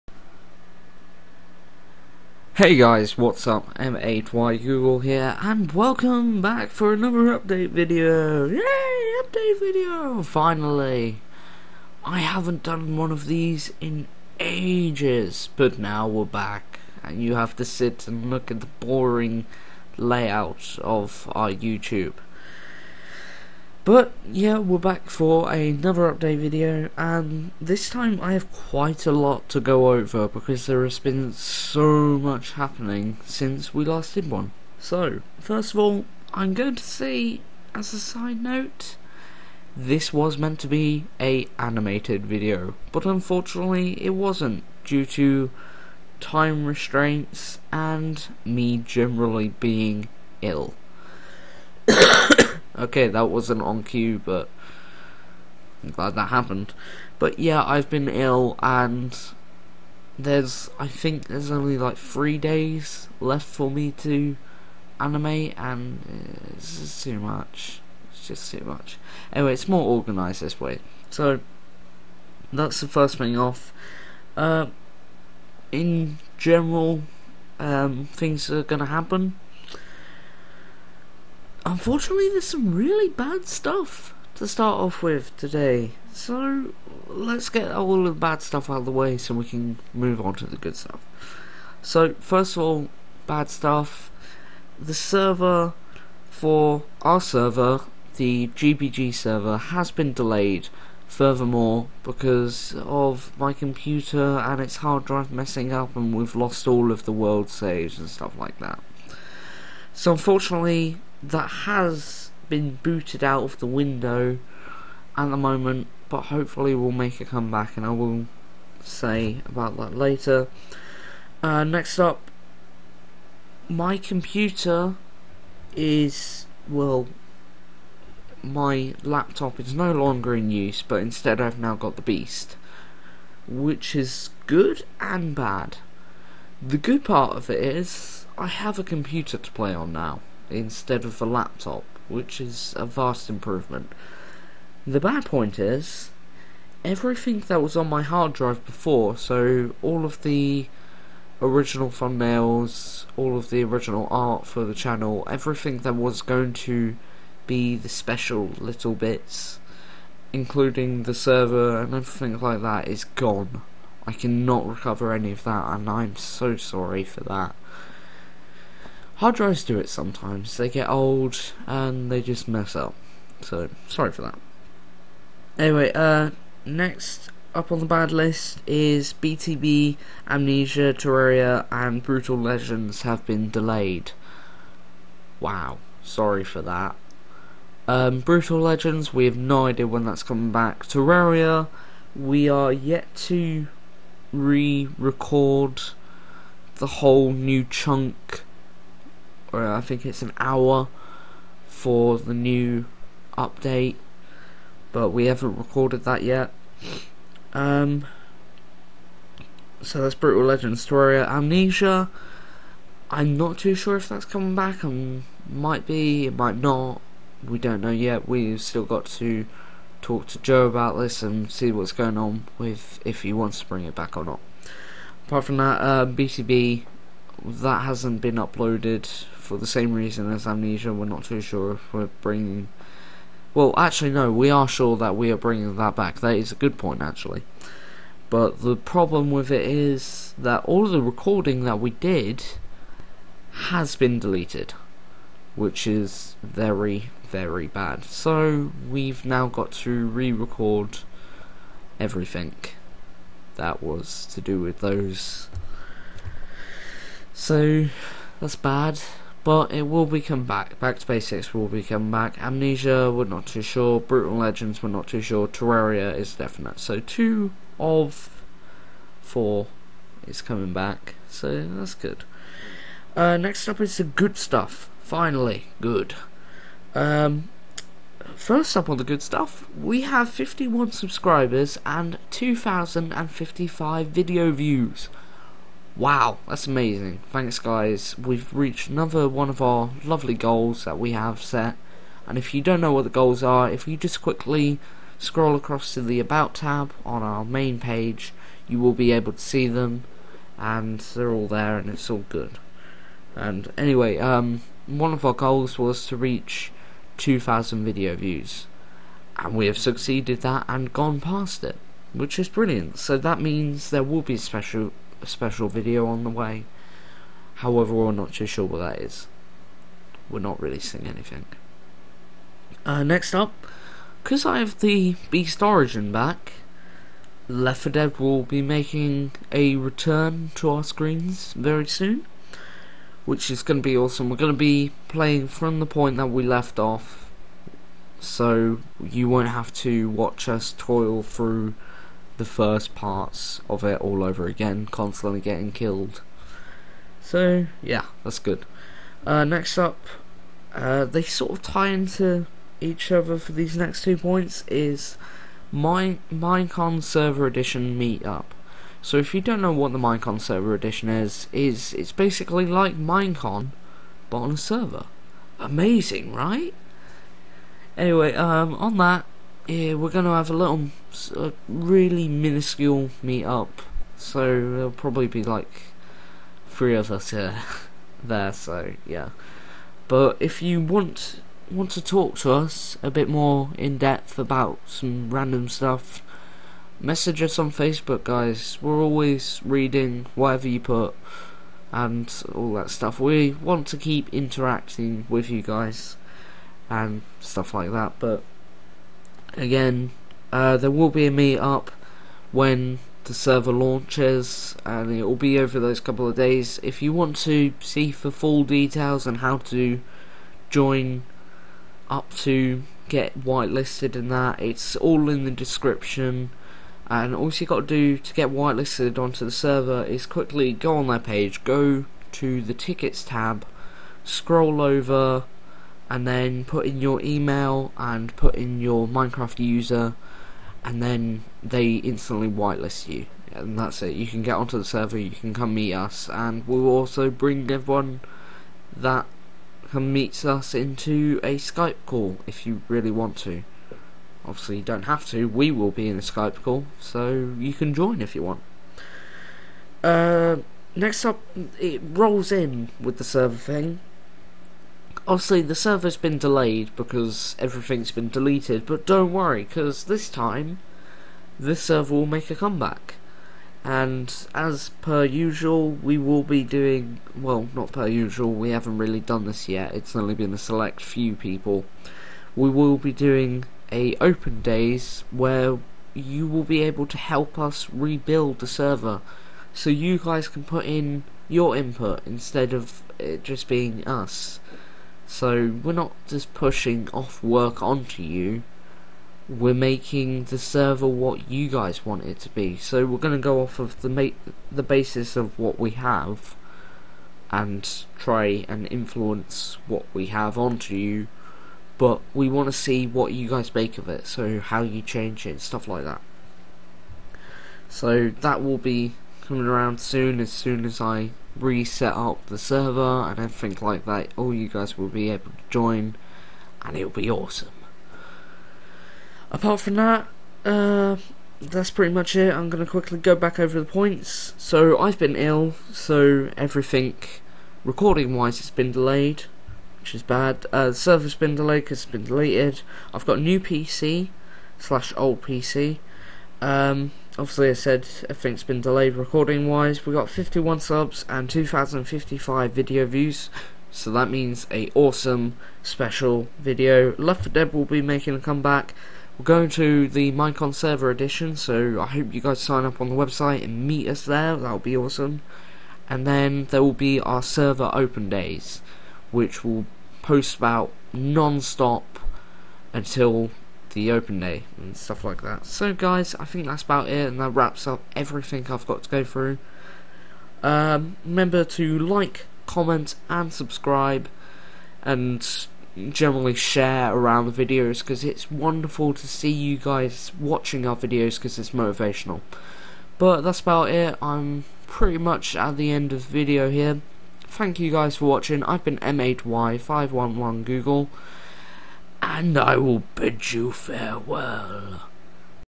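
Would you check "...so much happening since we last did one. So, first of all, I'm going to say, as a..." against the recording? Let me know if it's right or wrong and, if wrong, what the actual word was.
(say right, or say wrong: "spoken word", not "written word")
right.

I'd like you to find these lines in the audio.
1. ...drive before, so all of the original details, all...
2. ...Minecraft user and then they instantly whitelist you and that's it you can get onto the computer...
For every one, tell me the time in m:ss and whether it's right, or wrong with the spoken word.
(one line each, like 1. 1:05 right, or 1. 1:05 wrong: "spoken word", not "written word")
1. 2:28 wrong: "thumbnails", not "details"
2. 7:09 wrong: "server", not "computer".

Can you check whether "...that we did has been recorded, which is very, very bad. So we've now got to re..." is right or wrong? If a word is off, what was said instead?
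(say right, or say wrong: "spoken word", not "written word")
wrong: "deleted", not "recorded".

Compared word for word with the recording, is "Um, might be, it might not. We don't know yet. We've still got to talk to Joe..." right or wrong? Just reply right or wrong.
right.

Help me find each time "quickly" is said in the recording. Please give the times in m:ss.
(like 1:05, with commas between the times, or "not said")
4:54, 7:00, 8:42.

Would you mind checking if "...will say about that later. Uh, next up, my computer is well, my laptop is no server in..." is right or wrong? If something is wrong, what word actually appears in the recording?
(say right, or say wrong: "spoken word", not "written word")
wrong: "longer", not "server".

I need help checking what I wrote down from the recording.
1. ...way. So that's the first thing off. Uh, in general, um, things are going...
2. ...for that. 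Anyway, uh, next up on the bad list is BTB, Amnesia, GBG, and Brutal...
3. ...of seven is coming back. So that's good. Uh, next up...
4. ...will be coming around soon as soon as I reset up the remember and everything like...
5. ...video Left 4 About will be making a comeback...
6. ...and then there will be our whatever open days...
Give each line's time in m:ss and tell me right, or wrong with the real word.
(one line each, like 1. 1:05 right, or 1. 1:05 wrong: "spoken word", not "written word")
1. 1:10 right
2. 2:54 wrong: "Terraria", not "GBG"
3. 4:27 wrong: "four", not "seven"
4. 8:28 wrong: "server", not "remember"
5. 9:06 wrong: "Dead", not "About"
6. 9:16 wrong: "server", not "whatever".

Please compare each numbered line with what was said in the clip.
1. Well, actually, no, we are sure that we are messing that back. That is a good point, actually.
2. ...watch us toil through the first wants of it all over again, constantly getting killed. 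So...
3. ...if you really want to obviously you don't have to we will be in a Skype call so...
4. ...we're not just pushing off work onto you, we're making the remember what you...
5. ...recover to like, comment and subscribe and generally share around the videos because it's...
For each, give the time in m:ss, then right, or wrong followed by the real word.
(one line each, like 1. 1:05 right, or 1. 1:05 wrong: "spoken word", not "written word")
1. 3:53 wrong: "bringing", not "messing"
2. 5:40 wrong: "parts", not "wants"
3. 7:22 right
4. 8:05 wrong: "server", not "remember"
5. 9:31 wrong: "remember", not "recover".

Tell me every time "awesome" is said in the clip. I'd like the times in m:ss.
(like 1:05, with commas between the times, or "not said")
5:33, 8:37, 9:04, 9:14.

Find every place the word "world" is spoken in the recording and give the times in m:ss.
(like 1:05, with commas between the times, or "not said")
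1:47.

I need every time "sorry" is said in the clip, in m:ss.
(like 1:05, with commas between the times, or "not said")
2:46, 2:53, 3:06.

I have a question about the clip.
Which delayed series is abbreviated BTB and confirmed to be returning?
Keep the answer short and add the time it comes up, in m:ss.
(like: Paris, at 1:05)
Back to Basics, at 4:20.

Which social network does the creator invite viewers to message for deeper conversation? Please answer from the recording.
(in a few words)
Facebook.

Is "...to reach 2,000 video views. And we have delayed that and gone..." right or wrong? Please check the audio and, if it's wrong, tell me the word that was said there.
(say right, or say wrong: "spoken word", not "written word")
wrong: "succeeded", not "delayed".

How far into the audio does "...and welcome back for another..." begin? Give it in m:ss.
0:05.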